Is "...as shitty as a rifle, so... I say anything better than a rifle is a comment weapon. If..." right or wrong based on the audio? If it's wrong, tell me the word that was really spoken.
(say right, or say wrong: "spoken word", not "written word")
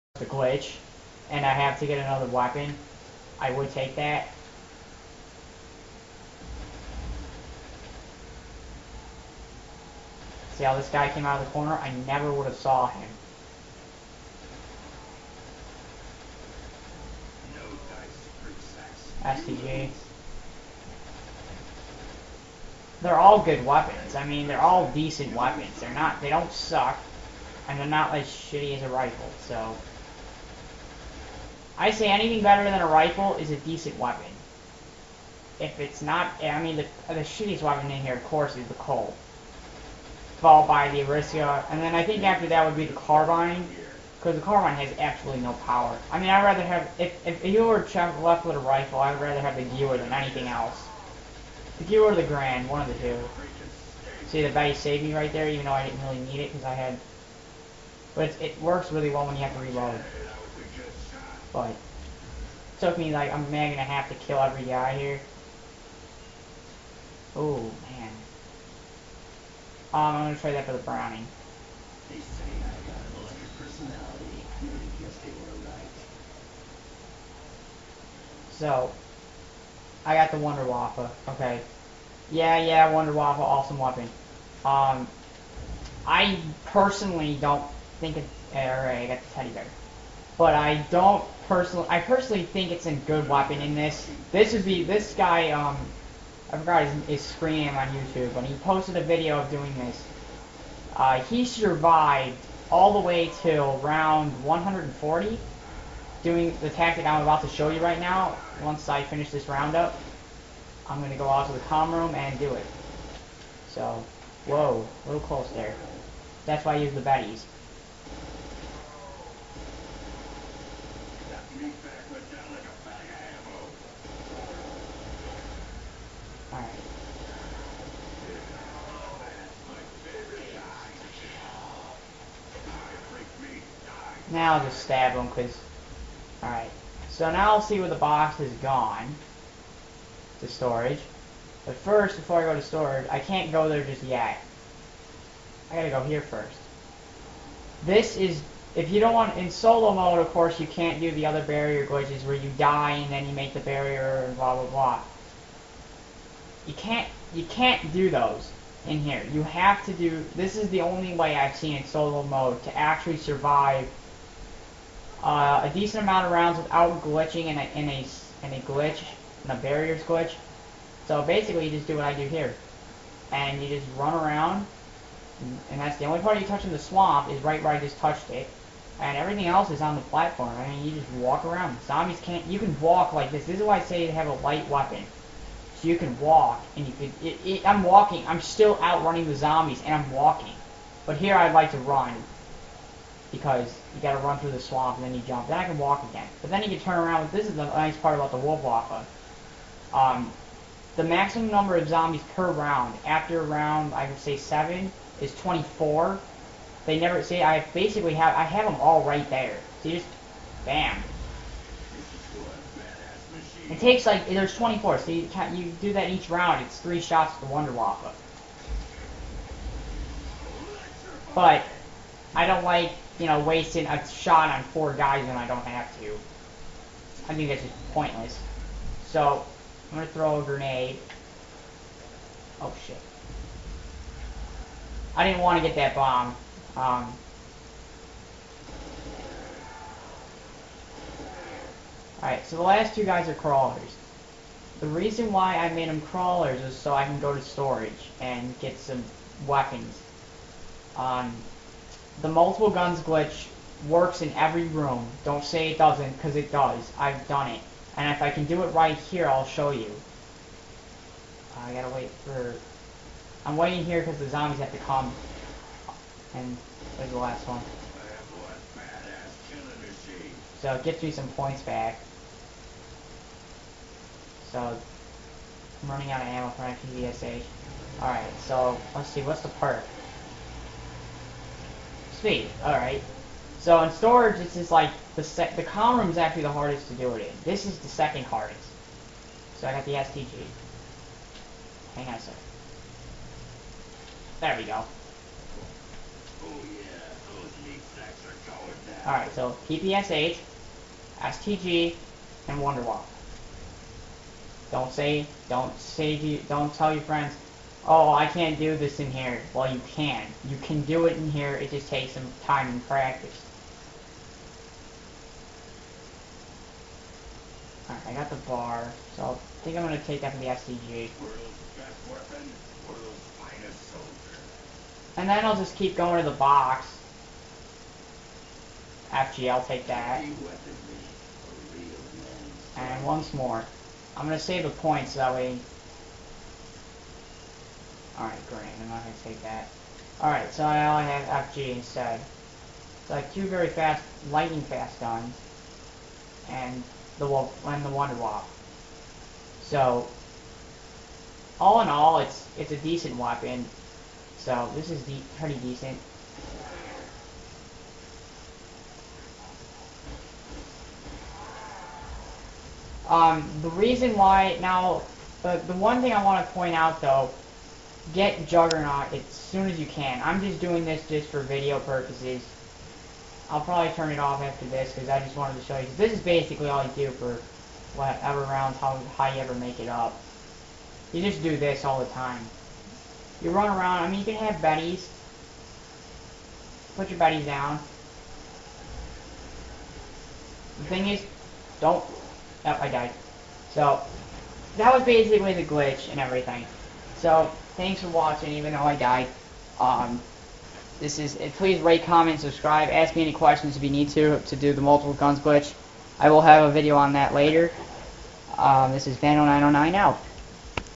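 wrong: "decent", not "comment".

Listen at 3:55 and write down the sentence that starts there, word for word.
I didn't want to get that bomb.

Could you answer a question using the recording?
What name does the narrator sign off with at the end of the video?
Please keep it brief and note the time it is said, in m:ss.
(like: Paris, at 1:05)
Bando909, at 6:49.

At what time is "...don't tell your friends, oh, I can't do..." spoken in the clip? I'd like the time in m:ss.
5:06.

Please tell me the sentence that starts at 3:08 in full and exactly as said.
I'm still outrunning the zombies, and I'm walking.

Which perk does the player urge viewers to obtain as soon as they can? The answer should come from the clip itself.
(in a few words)
Juggernaut.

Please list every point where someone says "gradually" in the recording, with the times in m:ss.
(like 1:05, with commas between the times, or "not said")
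not said.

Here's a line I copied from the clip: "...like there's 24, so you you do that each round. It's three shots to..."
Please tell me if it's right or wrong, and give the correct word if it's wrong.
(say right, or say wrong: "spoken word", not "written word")
right.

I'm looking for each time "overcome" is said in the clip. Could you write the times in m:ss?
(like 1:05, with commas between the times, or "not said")
not said.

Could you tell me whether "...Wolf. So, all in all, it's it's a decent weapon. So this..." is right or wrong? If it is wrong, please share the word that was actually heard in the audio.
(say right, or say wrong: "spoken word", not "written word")
right.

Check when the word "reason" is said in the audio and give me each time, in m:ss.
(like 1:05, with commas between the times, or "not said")
4:04, 6:03.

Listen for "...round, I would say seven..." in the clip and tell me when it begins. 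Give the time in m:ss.
3:23.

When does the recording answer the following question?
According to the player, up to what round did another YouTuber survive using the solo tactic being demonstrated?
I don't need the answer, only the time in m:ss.
1:43.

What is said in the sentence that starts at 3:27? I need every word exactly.
I basically have I have them all right there.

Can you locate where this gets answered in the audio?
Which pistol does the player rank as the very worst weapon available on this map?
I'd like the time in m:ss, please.
0:38.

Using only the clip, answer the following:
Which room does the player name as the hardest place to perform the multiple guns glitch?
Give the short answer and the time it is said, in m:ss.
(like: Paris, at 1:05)
column room, at 4:45.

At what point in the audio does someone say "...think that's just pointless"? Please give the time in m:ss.
3:47.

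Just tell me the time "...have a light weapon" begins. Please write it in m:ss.
3:04.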